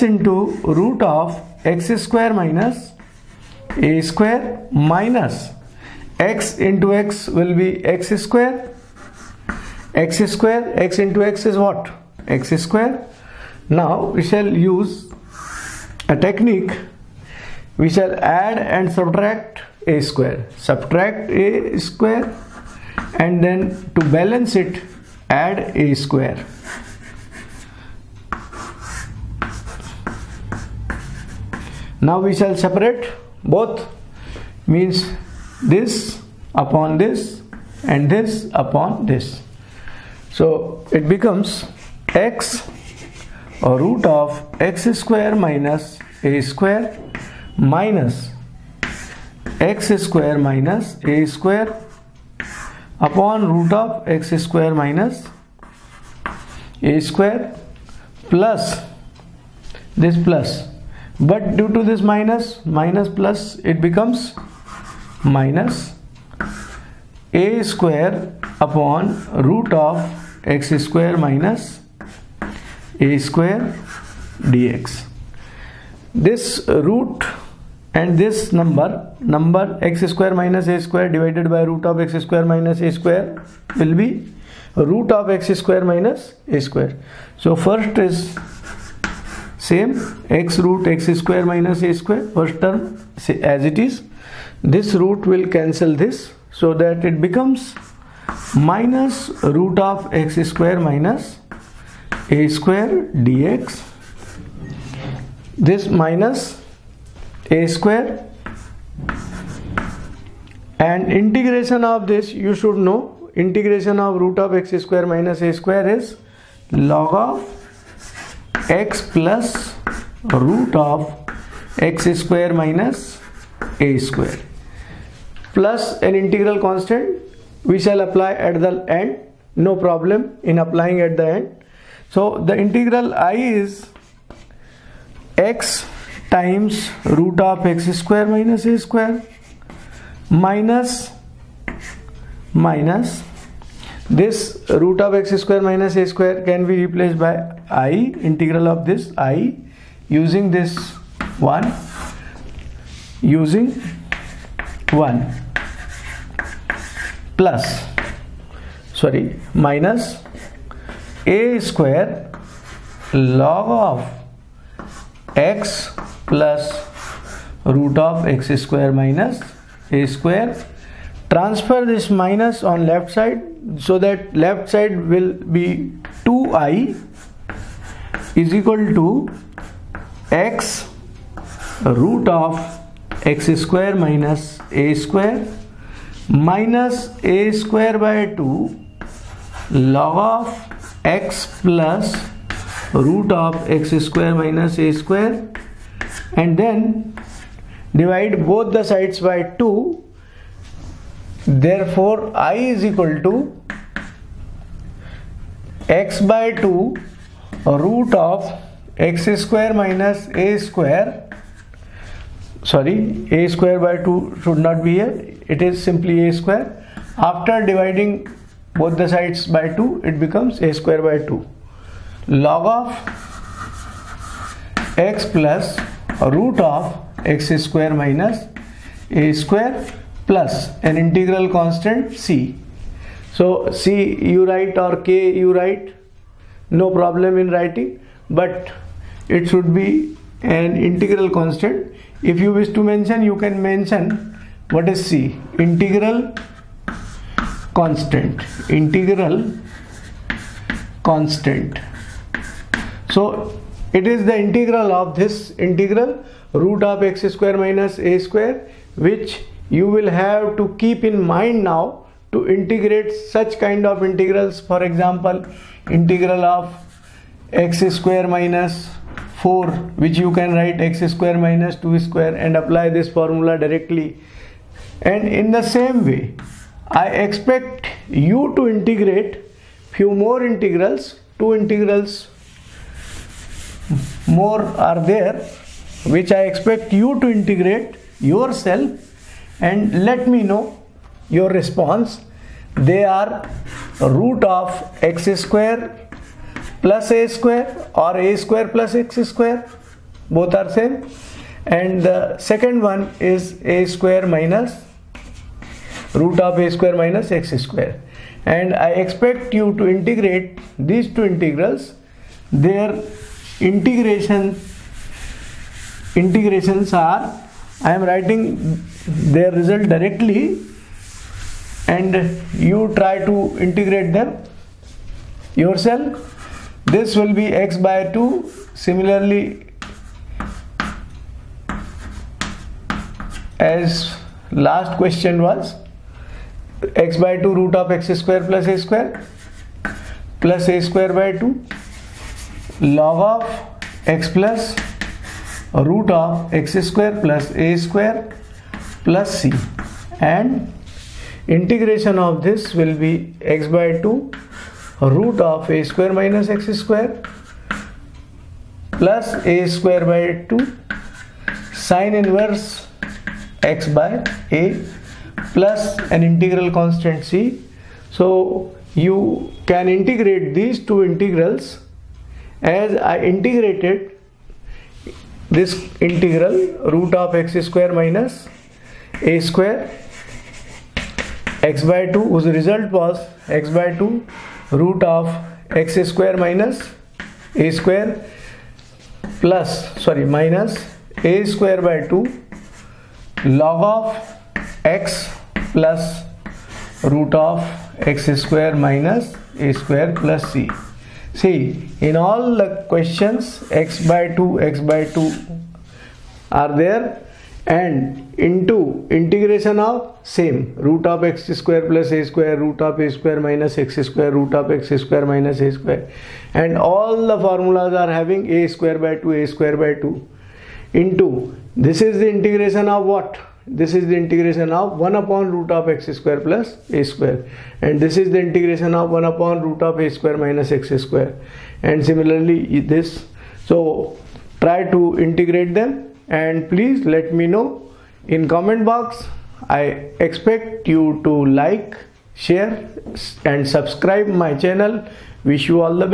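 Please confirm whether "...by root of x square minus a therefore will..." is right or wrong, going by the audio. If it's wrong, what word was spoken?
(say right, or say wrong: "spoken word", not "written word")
wrong: "square", not "therefore".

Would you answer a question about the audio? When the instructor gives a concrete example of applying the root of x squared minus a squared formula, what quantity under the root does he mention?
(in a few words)
x square minus 4.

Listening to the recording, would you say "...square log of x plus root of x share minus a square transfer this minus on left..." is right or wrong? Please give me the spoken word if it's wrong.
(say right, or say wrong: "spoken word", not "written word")
wrong: "square", not "share".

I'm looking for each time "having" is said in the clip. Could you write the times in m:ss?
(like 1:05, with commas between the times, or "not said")
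6:58.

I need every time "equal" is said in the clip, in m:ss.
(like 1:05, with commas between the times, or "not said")
2:58, 3:22.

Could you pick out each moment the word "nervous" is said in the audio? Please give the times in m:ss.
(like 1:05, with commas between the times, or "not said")
not said.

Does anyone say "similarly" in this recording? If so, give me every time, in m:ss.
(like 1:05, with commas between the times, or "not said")
5:28, 7:12.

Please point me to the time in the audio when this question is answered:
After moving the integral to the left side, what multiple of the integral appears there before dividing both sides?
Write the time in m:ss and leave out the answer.
2:56.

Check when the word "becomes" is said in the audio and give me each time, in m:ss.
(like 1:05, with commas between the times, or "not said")
0:41, 1:03, 1:37, 3:40.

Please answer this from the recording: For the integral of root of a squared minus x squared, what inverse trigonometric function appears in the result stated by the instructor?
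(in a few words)
sine inverse.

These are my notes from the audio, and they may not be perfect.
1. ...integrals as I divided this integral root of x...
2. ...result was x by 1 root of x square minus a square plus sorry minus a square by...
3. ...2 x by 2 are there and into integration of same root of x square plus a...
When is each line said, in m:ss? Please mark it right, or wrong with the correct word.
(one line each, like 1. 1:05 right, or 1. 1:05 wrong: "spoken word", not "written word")
1. 6:11 wrong: "integrated", not "divided"
2. 6:22 wrong: "2", not "1"
3. 6:44 right.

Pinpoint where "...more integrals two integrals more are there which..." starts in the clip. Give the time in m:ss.
4:40.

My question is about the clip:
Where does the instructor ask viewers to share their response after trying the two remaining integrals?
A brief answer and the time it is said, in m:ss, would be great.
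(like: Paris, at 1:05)
comment box, at 7:18.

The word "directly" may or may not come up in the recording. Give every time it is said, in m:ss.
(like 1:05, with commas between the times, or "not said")
4:33, 5:19.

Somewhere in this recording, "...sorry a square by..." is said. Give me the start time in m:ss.
3:32.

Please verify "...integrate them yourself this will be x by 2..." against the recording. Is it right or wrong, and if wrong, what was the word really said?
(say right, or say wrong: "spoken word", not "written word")
right.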